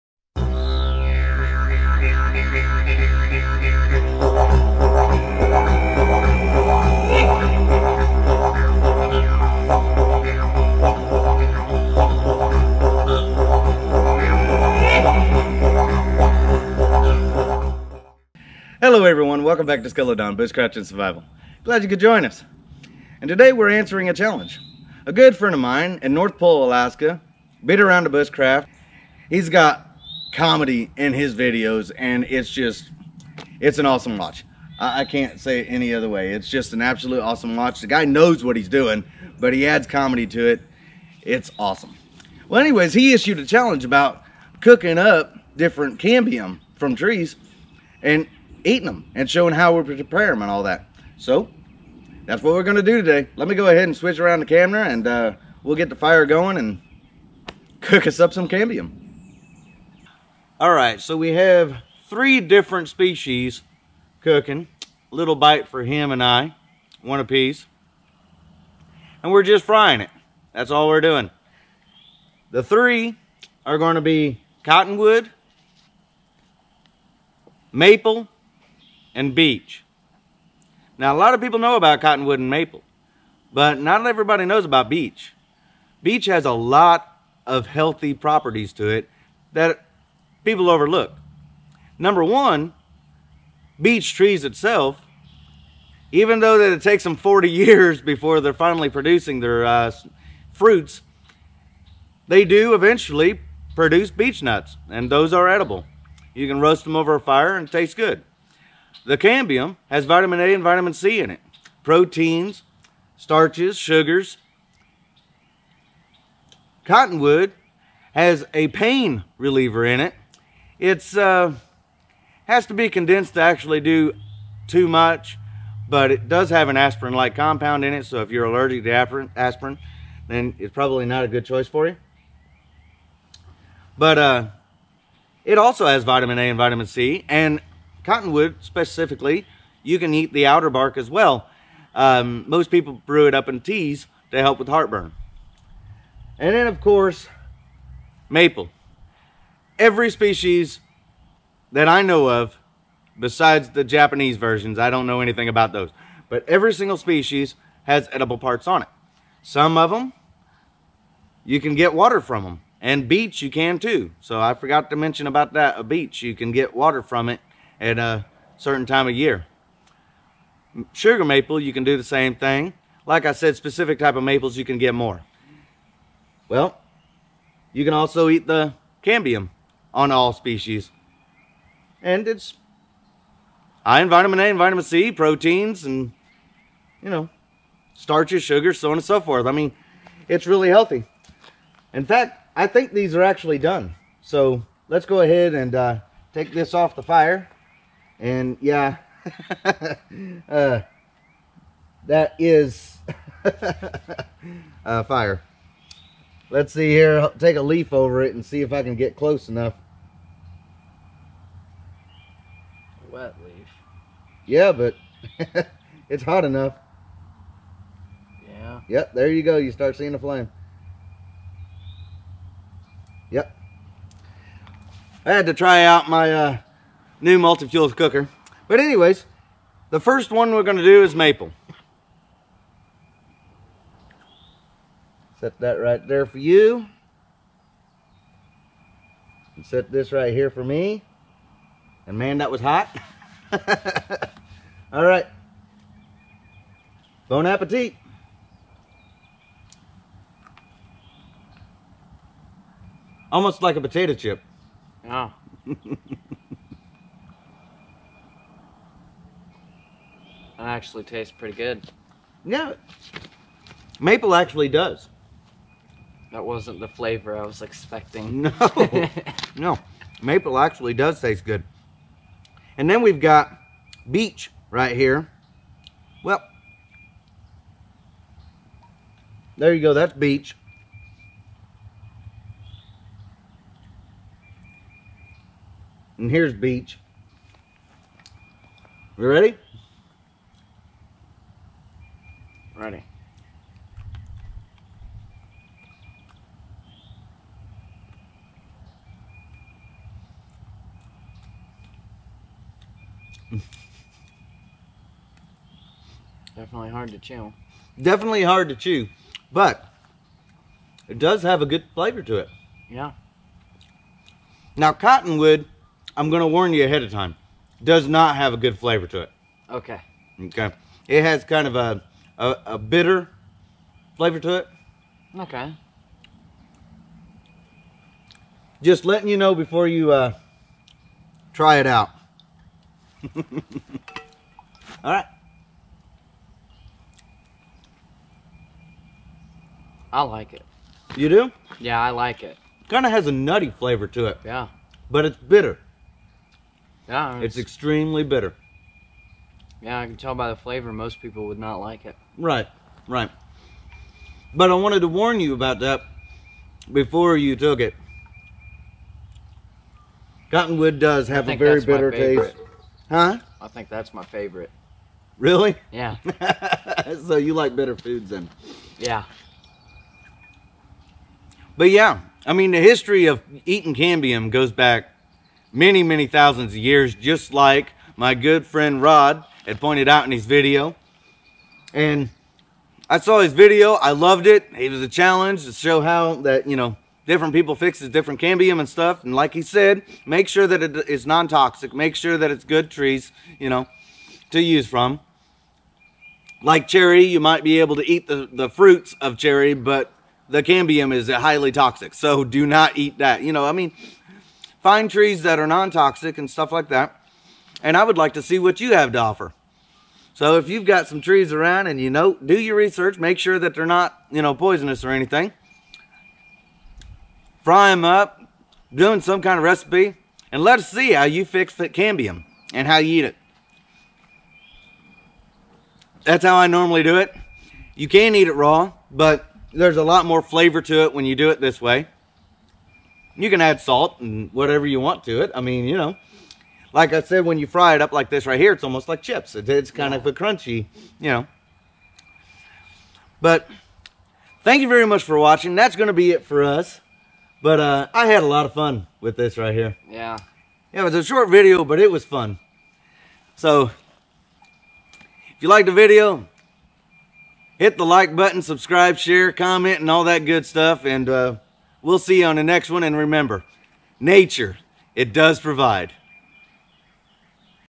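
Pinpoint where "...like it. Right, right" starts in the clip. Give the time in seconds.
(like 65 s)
351 s.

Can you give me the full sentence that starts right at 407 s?
And I would like to see what you have to offer.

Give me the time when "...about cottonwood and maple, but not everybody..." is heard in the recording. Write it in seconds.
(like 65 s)
81 s.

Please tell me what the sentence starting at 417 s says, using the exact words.
Fry them up, doing some kind of recipe, and let us see how you fix the cambium and how you eat it.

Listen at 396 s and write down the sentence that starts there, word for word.
Like cherry, you might be able to eat the, the fruits of cherry, but the cambium is highly toxic.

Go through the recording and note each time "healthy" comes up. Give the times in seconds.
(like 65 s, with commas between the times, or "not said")
87 s, 190 s.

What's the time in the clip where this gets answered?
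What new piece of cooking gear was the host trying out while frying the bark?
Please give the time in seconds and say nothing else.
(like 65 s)
227 s.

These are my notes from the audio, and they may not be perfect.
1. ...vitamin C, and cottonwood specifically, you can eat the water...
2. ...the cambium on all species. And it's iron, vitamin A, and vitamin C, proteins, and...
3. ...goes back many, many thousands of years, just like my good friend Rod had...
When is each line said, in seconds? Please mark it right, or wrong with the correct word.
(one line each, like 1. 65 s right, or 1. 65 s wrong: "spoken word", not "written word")
1. 136 s wrong: "outer", not "water"
2. 178 s right
3. 374 s right.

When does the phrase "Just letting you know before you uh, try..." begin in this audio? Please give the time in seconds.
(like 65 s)
328 s.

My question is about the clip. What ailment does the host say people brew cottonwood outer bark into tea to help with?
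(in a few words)
heartburn.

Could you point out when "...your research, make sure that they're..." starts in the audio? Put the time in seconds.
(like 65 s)
412 s.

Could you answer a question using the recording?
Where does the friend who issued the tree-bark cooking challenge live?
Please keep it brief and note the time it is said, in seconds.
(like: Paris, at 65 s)
North Pole, Alaska, at 26 s.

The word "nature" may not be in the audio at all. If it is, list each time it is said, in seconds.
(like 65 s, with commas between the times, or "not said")
464 s.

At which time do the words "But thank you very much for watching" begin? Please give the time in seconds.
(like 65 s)
443 s.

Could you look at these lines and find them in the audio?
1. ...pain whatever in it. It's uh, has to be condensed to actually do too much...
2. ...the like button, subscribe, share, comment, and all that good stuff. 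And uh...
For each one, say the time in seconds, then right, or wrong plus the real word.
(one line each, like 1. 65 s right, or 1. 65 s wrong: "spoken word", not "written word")
1. 118 s wrong: "reliever", not "whatever"
2. 457 s right.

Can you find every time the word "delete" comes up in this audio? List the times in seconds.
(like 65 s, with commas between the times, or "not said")
not said.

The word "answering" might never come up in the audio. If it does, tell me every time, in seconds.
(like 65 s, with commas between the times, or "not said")
23 s.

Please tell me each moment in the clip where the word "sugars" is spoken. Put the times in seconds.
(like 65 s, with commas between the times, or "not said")
113 s, 170 s, 188 s.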